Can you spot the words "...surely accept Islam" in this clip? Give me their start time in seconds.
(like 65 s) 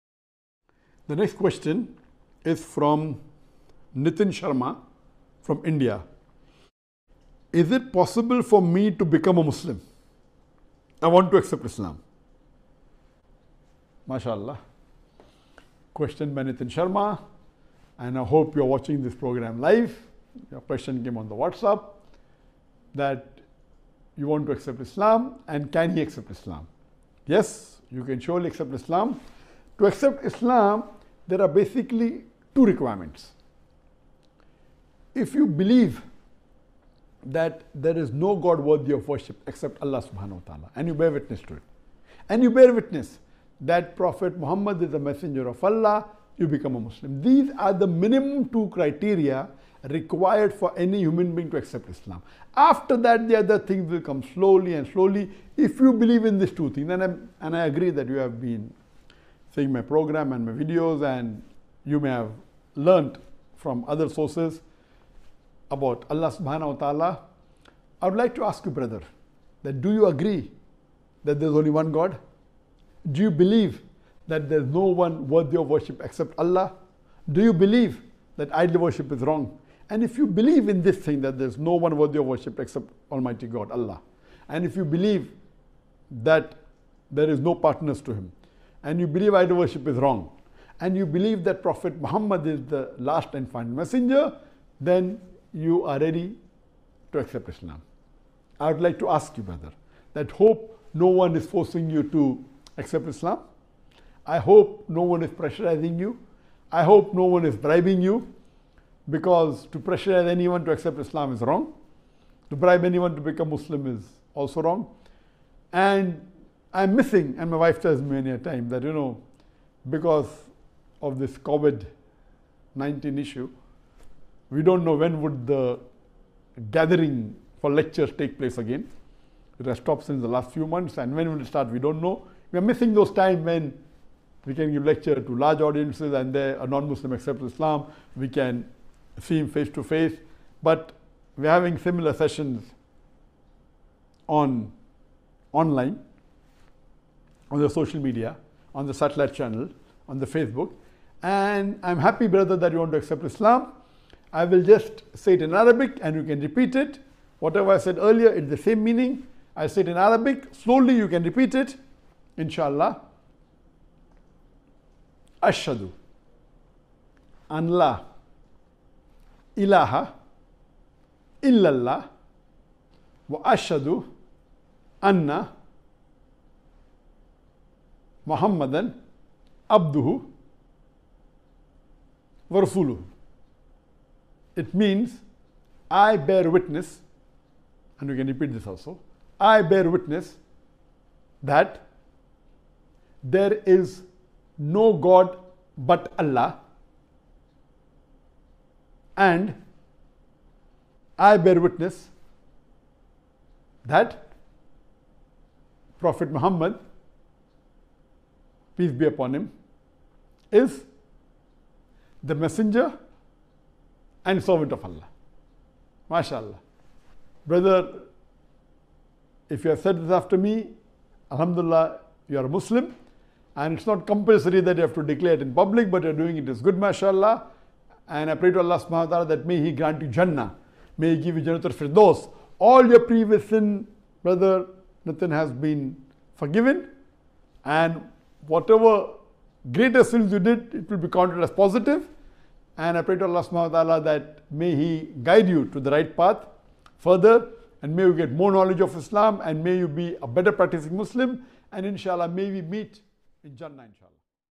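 28 s.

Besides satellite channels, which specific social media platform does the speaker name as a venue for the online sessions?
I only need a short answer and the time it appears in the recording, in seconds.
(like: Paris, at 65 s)
Facebook, at 150 s.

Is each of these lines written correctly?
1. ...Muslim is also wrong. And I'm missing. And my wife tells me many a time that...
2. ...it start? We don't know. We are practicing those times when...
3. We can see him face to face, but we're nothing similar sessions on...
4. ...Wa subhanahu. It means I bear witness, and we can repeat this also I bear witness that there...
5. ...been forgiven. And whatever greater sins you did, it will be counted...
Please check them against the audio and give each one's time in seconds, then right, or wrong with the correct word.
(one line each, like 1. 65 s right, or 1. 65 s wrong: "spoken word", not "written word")
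1. 113 s right
2. 131 s wrong: "missing", not "practicing"
3. 138 s wrong: "having", not "nothing"
4. 182 s wrong: "rasuluhu", not "subhanahu"
5. 235 s right.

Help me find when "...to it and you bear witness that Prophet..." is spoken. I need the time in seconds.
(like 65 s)
41 s.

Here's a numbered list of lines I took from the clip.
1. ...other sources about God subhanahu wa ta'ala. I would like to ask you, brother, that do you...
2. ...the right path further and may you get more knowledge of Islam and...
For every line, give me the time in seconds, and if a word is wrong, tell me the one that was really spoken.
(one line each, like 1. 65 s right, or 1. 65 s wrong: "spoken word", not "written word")
1. 63 s wrong: "Allah", not "God"
2. 245 s right.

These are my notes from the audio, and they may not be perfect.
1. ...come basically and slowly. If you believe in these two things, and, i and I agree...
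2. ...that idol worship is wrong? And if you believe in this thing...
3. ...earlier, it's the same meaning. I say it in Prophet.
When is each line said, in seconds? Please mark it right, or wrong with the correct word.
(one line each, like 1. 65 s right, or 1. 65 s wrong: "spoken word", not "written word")
1. 54 s wrong: "slowly", not "basically"
2. 78 s right
3. 157 s wrong: "Arabic", not "Prophet".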